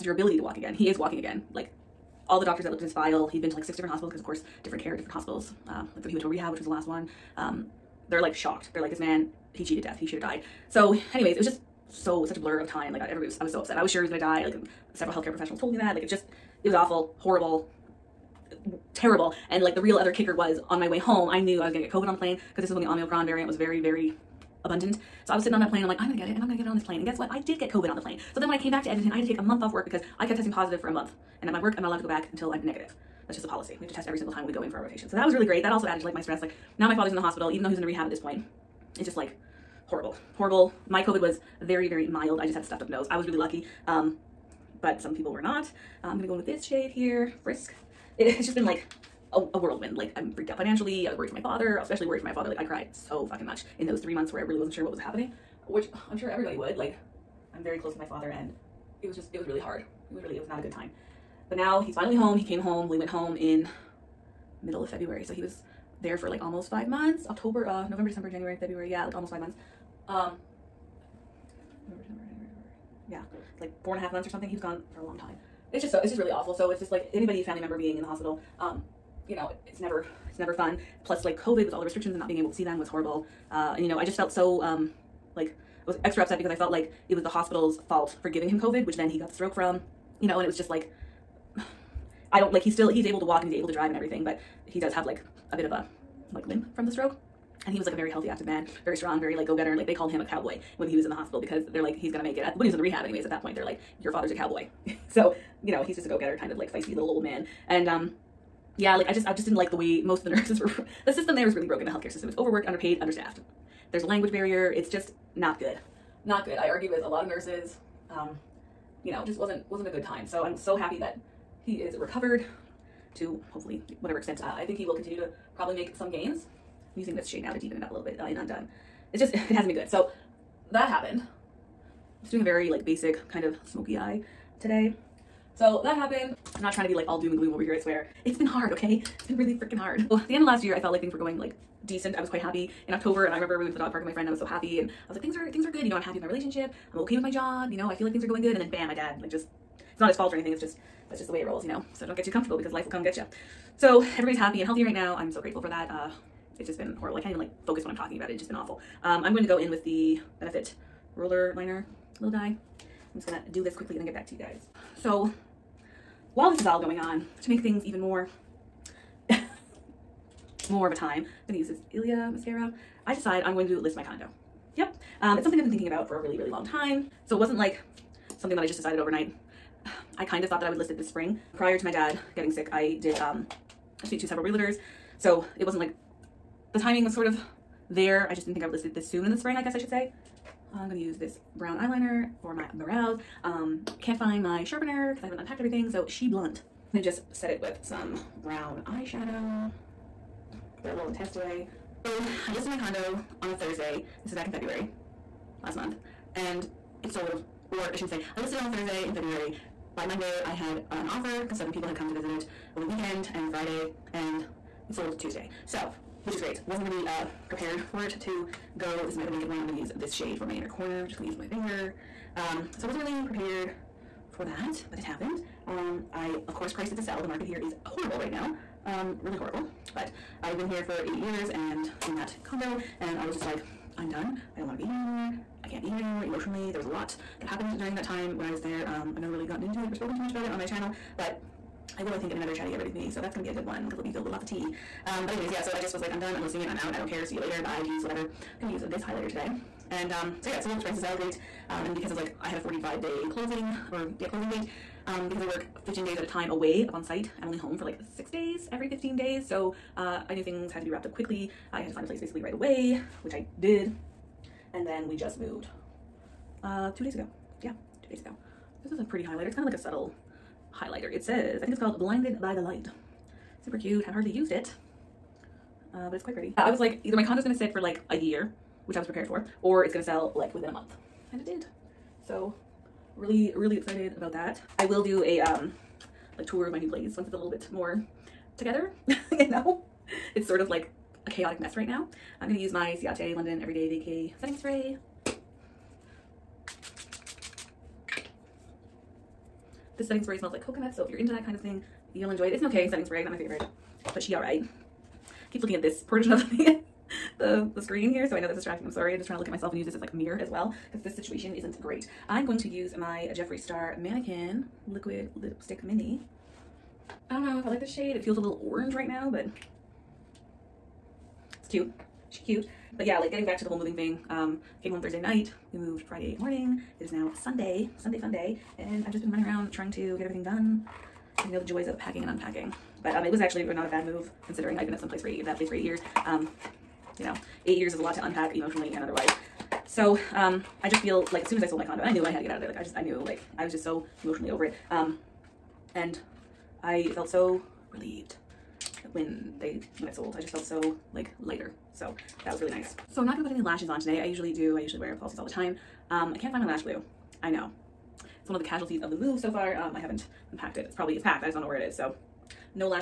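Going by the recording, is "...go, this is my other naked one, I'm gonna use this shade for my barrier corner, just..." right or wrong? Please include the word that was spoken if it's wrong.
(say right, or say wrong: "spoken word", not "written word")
wrong: "inner", not "barrier".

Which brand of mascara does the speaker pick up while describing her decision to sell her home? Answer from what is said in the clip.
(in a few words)
Ilia.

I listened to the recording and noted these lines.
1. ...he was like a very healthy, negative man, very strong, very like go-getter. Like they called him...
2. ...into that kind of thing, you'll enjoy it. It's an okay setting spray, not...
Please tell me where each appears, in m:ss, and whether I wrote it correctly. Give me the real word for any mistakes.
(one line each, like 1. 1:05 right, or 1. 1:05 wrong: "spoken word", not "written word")
1. 1:37 wrong: "active", not "negative"
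2. 5:01 right.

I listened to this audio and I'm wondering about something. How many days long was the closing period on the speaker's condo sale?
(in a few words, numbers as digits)
45.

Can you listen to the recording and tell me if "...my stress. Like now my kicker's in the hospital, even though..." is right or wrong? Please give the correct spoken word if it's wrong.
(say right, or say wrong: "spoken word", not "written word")
wrong: "father", not "kicker".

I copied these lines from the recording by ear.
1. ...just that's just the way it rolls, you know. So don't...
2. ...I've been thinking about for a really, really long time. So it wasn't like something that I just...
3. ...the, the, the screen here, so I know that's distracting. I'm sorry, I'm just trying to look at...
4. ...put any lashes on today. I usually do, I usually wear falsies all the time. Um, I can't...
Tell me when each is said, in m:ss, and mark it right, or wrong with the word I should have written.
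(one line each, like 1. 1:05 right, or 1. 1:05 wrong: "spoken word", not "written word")
1. 2:30 right
2. 2:55 right
3. 5:06 right
4. 5:53 right.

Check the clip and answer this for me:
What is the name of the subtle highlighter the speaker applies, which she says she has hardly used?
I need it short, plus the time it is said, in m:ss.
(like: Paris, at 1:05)
Blinded by the Light, at 4:31.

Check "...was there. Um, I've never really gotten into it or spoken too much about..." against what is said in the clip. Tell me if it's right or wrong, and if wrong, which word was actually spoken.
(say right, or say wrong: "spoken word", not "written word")
right.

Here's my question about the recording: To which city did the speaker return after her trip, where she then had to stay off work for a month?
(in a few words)
Edmonton.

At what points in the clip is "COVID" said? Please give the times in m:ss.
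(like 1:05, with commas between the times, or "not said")
0:21, 0:27, 0:41, 1:21, 1:28.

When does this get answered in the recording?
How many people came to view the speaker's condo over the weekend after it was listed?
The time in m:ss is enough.
3:31.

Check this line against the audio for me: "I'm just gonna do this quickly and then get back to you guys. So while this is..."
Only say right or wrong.
right.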